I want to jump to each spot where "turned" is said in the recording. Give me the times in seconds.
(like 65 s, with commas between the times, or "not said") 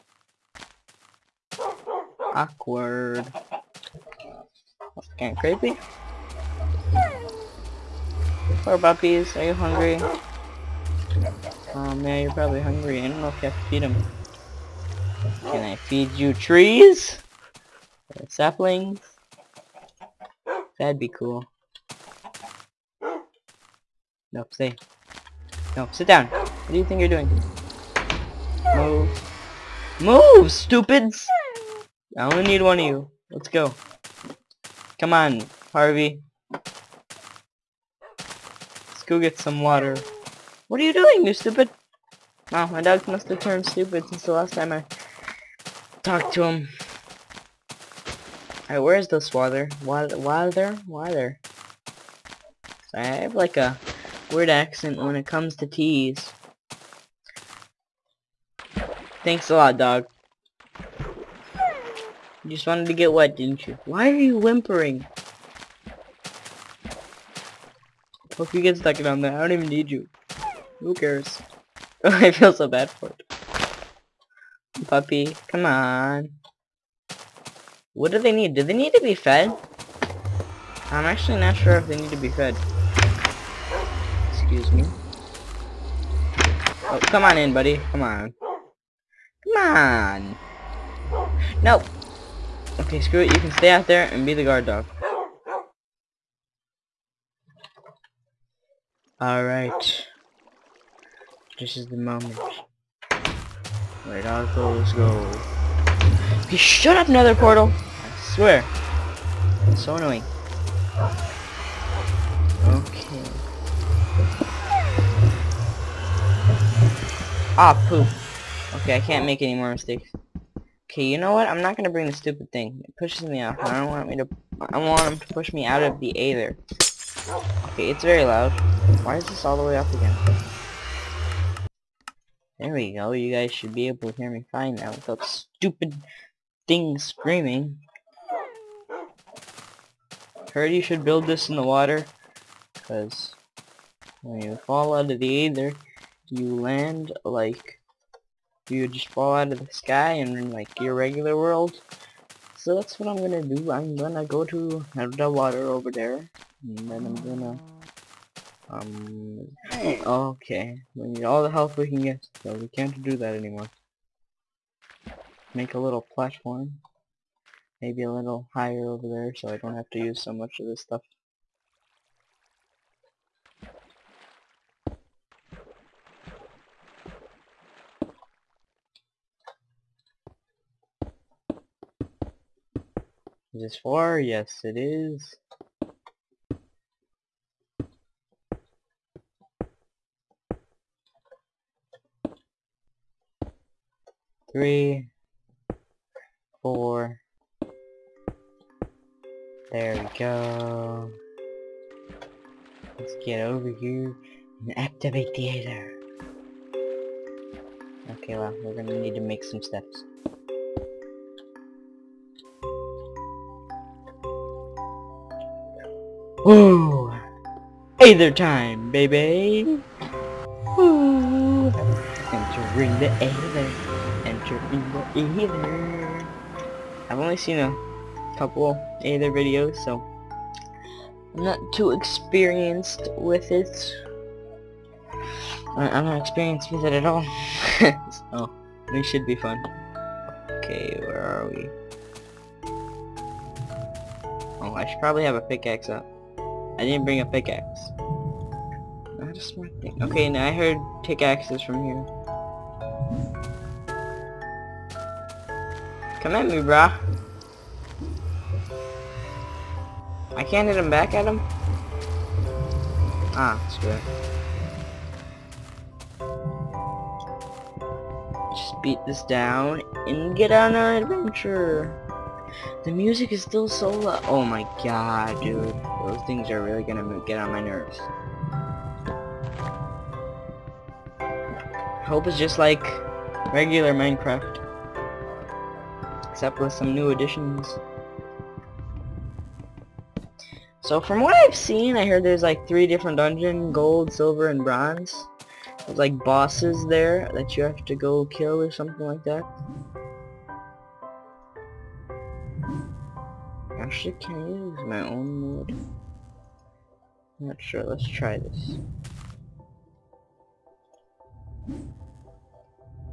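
43 s.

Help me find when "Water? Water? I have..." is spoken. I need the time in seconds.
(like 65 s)
50 s.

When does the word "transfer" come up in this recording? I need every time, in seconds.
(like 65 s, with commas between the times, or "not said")
not said.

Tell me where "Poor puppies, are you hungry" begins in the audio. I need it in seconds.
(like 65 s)
8 s.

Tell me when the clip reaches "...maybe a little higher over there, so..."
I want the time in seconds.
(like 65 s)
167 s.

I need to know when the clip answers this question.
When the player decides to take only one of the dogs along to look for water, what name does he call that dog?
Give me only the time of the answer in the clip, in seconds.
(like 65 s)
35 s.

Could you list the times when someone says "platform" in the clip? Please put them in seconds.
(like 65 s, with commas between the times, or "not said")
166 s.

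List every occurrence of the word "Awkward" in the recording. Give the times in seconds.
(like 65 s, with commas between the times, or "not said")
2 s.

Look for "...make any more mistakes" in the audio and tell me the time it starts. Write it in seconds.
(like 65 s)
119 s.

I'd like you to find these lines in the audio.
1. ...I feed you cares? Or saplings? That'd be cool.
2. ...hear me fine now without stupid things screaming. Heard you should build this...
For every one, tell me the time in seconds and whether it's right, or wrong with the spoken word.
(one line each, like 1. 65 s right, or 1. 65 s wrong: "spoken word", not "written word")
1. 15 s wrong: "trees", not "cares"
2. 134 s right.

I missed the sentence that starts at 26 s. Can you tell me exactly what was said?
What do you think you're doing?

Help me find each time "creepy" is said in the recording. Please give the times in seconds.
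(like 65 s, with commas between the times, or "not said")
5 s.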